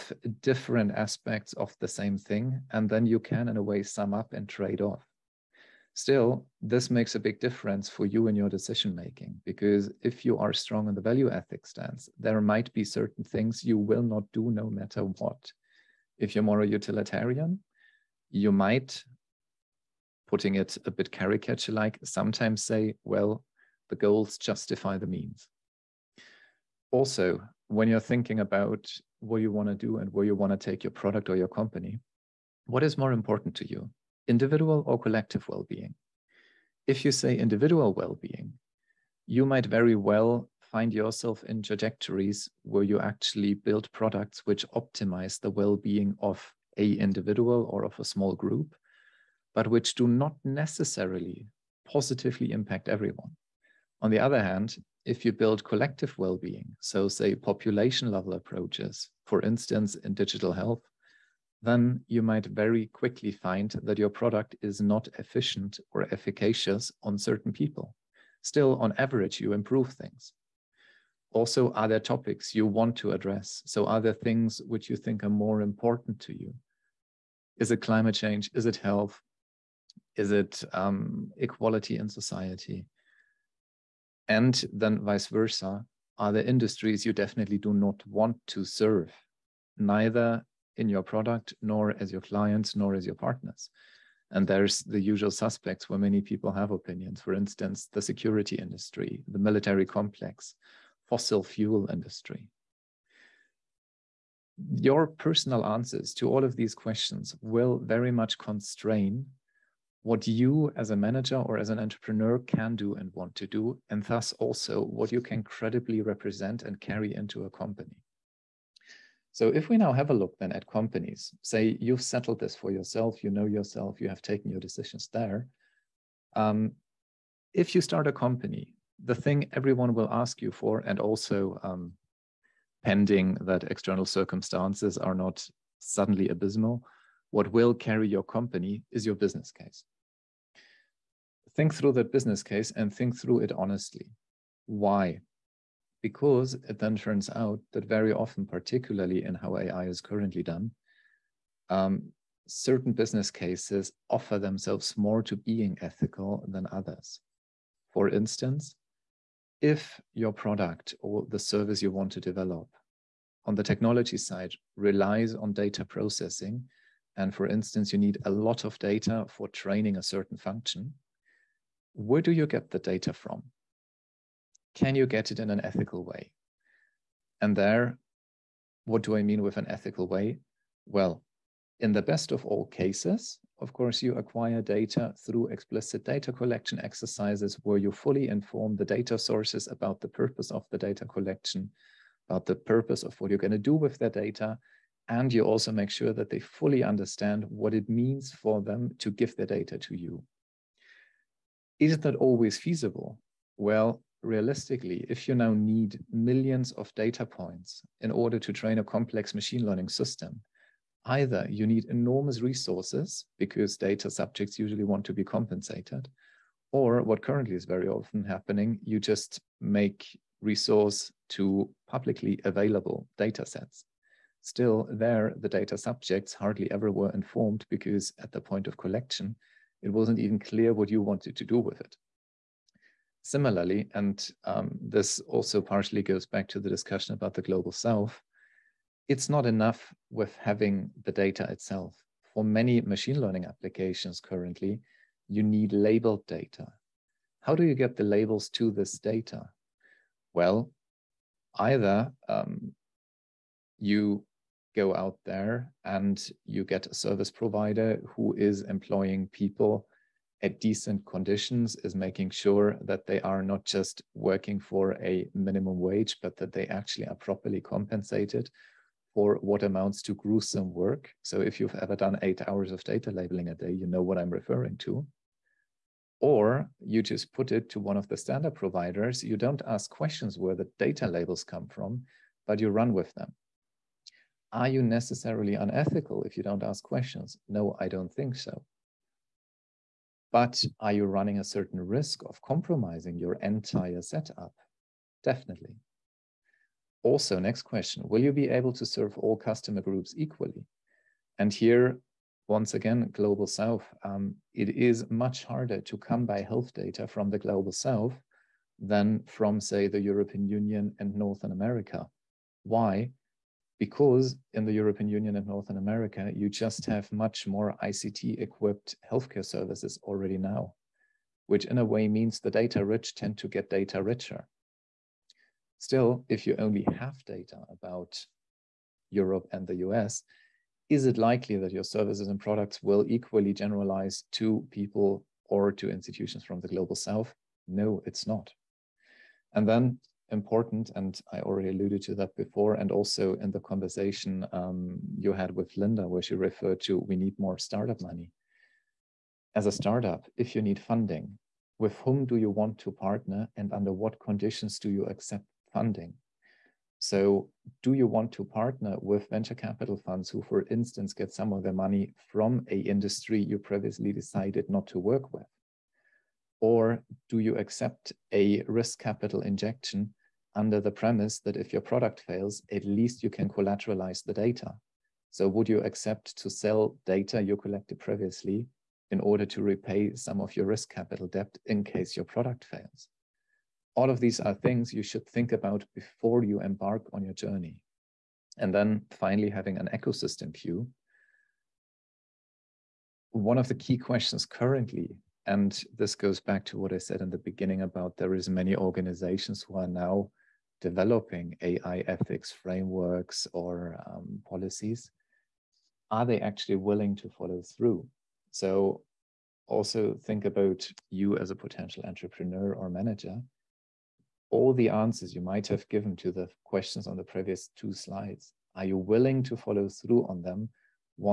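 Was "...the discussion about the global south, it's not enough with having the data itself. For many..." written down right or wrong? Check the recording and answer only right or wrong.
right.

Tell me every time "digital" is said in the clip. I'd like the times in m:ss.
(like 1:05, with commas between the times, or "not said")
1:00.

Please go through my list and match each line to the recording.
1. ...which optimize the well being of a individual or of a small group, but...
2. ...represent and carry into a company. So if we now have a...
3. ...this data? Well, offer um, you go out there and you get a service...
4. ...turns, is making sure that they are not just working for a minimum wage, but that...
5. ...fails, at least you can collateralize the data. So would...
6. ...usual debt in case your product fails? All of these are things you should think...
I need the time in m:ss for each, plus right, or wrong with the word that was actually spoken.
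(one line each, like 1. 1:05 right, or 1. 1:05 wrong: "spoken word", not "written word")
1. 0:44 right
2. 1:56 right
3. 4:08 wrong: "either", not "offer"
4. 4:21 wrong: "conditions", not "turns"
5. 6:12 right
6. 6:20 wrong: "capital", not "usual".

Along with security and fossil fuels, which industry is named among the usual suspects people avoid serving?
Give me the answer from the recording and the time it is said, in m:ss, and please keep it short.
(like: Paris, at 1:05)
military complex, at 1:39.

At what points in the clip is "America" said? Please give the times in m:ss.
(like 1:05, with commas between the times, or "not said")
5:11, 5:15.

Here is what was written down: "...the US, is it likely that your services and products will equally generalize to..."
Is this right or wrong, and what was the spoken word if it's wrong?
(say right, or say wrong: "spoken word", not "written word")
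right.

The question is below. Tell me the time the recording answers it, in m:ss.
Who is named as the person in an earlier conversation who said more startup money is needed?
5:45.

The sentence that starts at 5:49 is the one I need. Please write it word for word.
As a startup, if you need funding, with whom do you want to partner, and under what conditions do you accept funding?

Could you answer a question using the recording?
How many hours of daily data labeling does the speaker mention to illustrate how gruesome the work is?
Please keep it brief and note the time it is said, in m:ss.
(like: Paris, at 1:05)
8, at 4:32.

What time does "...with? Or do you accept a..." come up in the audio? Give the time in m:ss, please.
6:05.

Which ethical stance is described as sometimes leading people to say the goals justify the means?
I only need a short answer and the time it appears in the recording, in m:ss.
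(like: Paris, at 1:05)
utilitarian, at 0:16.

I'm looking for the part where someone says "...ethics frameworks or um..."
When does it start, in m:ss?
6:42.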